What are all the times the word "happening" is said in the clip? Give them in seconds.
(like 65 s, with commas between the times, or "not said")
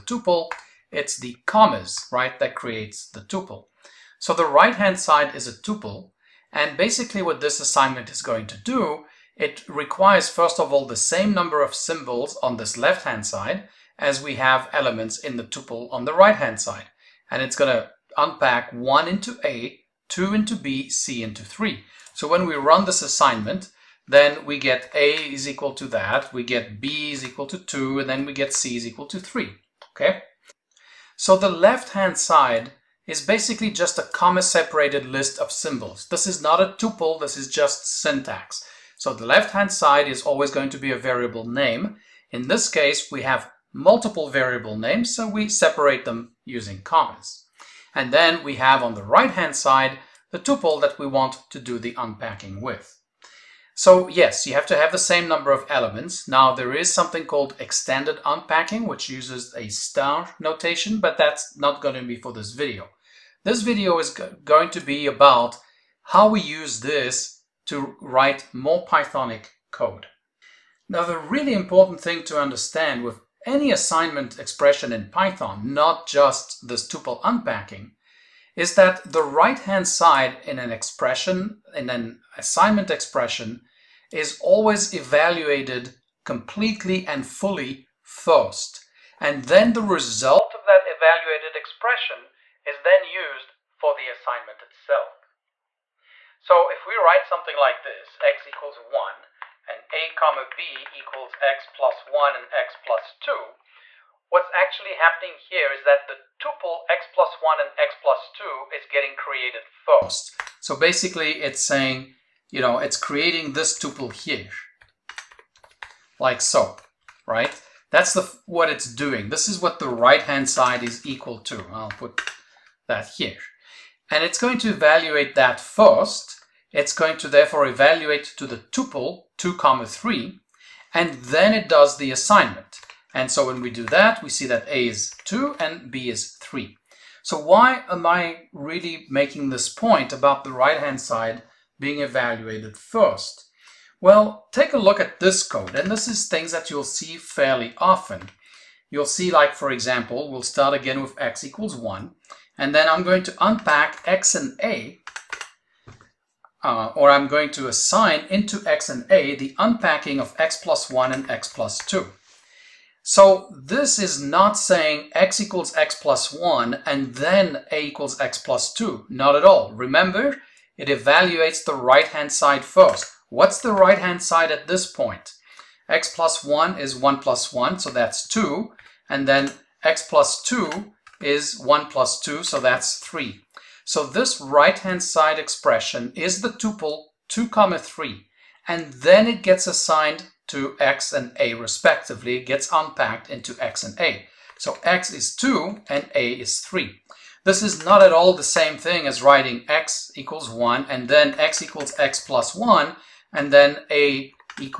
104 s.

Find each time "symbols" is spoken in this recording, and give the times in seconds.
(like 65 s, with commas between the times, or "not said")
11 s, 35 s.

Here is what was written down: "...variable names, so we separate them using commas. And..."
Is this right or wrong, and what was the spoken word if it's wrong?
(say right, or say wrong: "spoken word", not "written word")
right.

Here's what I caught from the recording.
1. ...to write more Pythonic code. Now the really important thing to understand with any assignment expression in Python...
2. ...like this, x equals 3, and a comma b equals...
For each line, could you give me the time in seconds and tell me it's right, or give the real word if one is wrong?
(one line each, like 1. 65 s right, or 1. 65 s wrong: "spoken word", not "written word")
1. 67 s right
2. 97 s wrong: "1", not "3".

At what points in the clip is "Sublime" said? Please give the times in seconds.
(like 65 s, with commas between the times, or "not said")
not said.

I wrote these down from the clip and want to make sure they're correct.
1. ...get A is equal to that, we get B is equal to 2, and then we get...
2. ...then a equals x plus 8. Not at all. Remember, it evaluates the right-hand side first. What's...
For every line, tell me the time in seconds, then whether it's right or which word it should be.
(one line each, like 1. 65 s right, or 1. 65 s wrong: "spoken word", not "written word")
1. 24 s right
2. 167 s wrong: "2", not "8".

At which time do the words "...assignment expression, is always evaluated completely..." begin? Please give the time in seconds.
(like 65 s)
82 s.